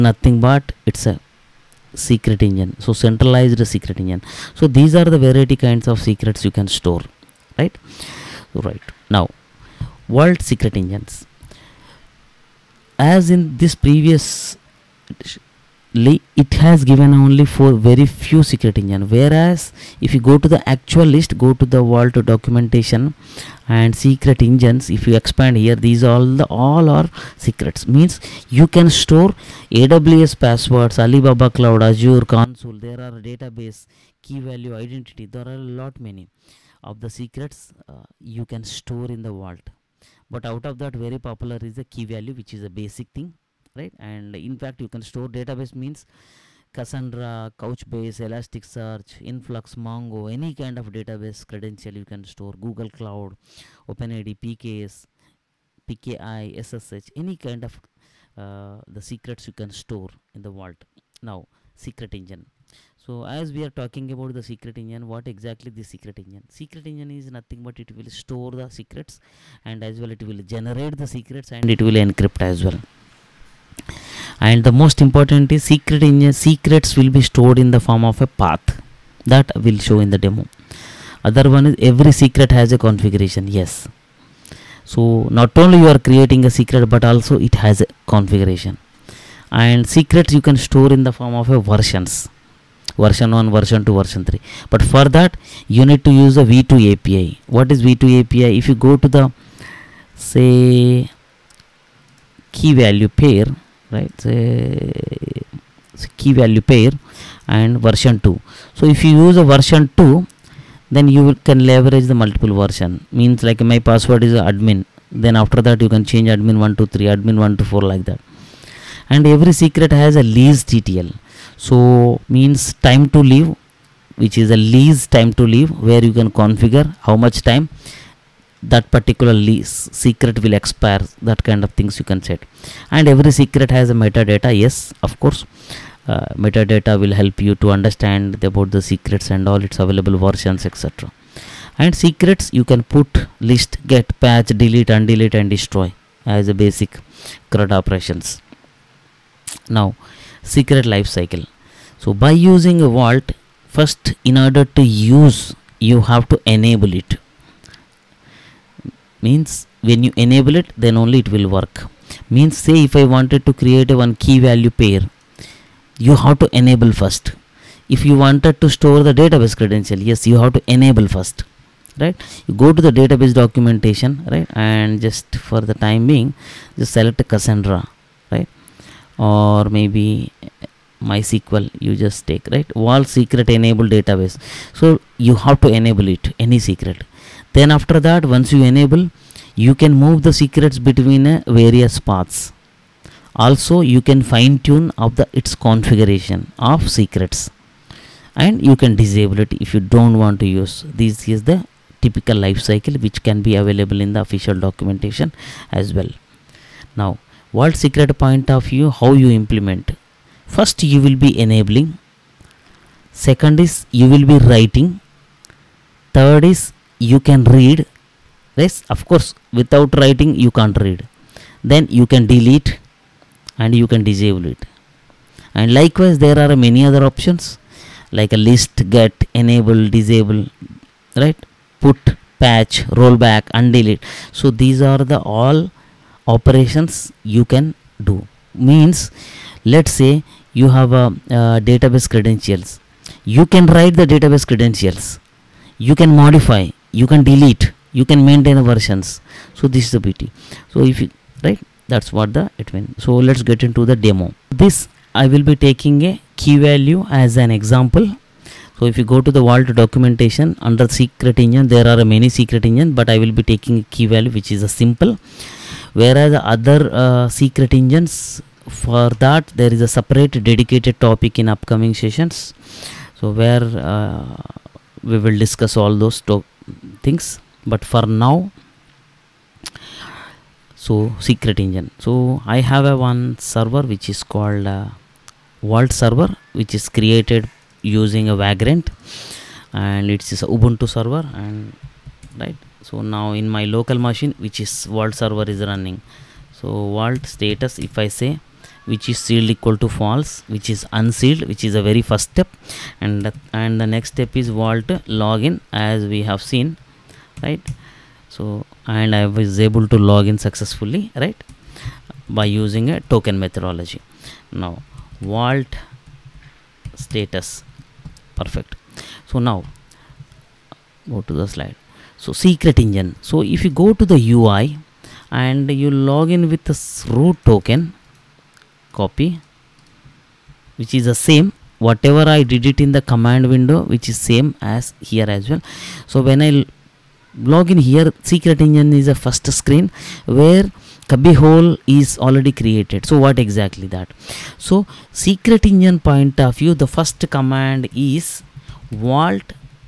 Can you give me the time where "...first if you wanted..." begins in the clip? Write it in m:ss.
2:47.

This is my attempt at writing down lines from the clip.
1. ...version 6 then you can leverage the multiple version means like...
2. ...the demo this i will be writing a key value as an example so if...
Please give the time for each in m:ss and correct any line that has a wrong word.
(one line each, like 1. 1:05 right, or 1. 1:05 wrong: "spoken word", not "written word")
1. 1:49 wrong: "2", not "6"
2. 4:13 wrong: "taking", not "writing".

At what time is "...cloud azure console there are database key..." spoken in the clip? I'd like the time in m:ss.
0:31.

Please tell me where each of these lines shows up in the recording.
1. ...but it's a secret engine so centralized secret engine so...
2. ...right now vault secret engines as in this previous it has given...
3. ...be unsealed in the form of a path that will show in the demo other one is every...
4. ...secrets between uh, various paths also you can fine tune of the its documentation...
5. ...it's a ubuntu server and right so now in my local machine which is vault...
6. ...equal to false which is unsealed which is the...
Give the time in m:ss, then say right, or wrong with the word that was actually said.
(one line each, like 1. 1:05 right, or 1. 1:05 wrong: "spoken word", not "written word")
1. 0:00 right
2. 0:08 right
3. 1:17 wrong: "stored", not "unsealed"
4. 3:10 wrong: "configuration", not "documentation"
5. 4:50 right
6. 4:59 right.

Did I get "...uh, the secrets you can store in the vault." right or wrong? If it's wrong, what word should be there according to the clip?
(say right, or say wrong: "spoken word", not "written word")
right.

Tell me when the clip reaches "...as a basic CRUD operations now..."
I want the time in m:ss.
2:26.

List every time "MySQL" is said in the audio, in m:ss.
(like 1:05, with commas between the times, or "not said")
3:01.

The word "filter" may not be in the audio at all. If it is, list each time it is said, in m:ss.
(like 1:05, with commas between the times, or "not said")
not said.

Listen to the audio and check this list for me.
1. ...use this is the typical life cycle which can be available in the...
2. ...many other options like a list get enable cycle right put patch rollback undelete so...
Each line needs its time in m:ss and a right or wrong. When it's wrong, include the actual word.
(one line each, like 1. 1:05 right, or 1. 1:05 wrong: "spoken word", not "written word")
1. 3:20 right
2. 3:46 wrong: "disable", not "cycle".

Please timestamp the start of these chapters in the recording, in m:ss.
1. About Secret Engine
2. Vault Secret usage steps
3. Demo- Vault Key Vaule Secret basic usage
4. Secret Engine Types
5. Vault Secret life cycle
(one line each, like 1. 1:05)
1. 1:01
2. 3:27
3. 4:13
4. 0:08
5. 2:28.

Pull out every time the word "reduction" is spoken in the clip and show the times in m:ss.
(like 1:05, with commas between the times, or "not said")
not said.